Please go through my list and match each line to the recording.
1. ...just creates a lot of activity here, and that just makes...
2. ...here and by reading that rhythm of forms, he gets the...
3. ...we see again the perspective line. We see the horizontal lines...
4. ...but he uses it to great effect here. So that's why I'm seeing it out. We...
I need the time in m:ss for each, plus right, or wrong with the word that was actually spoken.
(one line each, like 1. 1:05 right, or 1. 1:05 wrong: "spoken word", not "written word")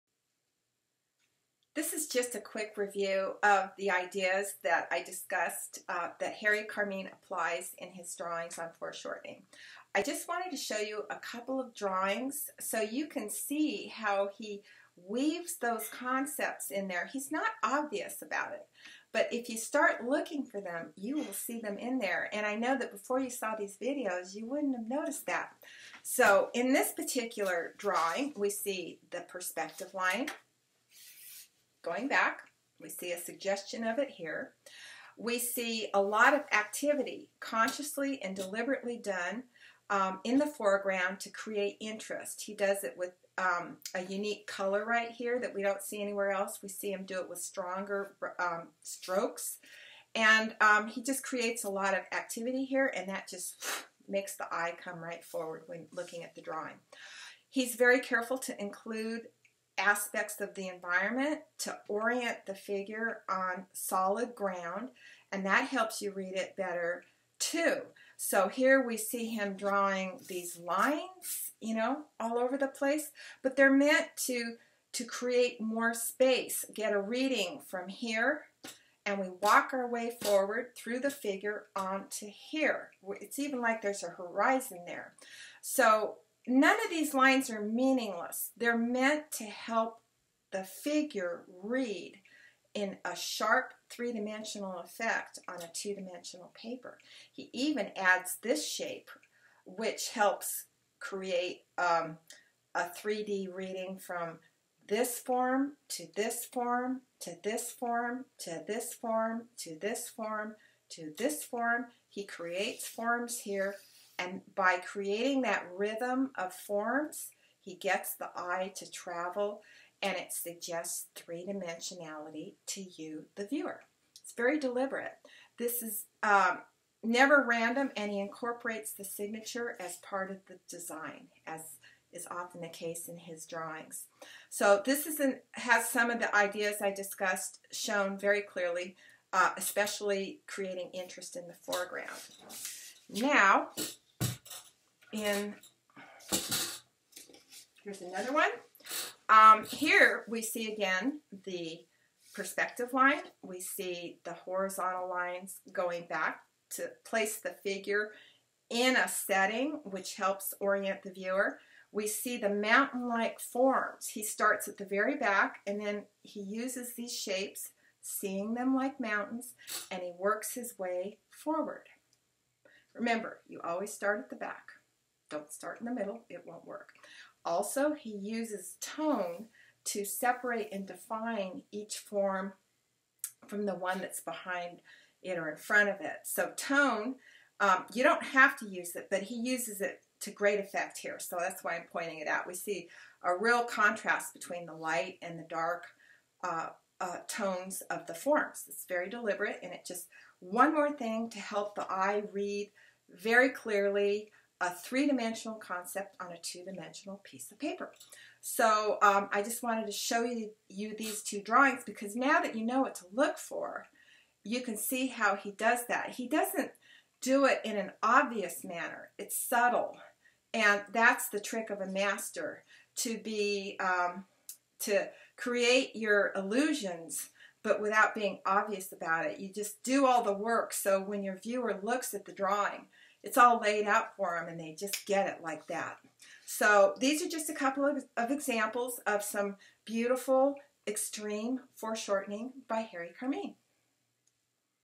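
1. 0:51 right
2. 1:53 wrong: "creating", not "reading"
3. 2:30 right
4. 3:09 wrong: "pointing", not "seeing".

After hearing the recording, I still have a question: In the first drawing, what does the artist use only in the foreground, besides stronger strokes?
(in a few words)
A unique color.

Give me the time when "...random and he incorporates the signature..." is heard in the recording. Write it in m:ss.
2:07.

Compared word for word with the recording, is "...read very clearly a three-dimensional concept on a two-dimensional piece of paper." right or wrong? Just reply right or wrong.
right.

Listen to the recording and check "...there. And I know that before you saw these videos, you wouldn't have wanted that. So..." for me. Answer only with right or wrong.
wrong.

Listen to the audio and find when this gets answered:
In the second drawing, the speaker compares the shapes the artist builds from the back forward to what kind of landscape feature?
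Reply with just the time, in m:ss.
2:42.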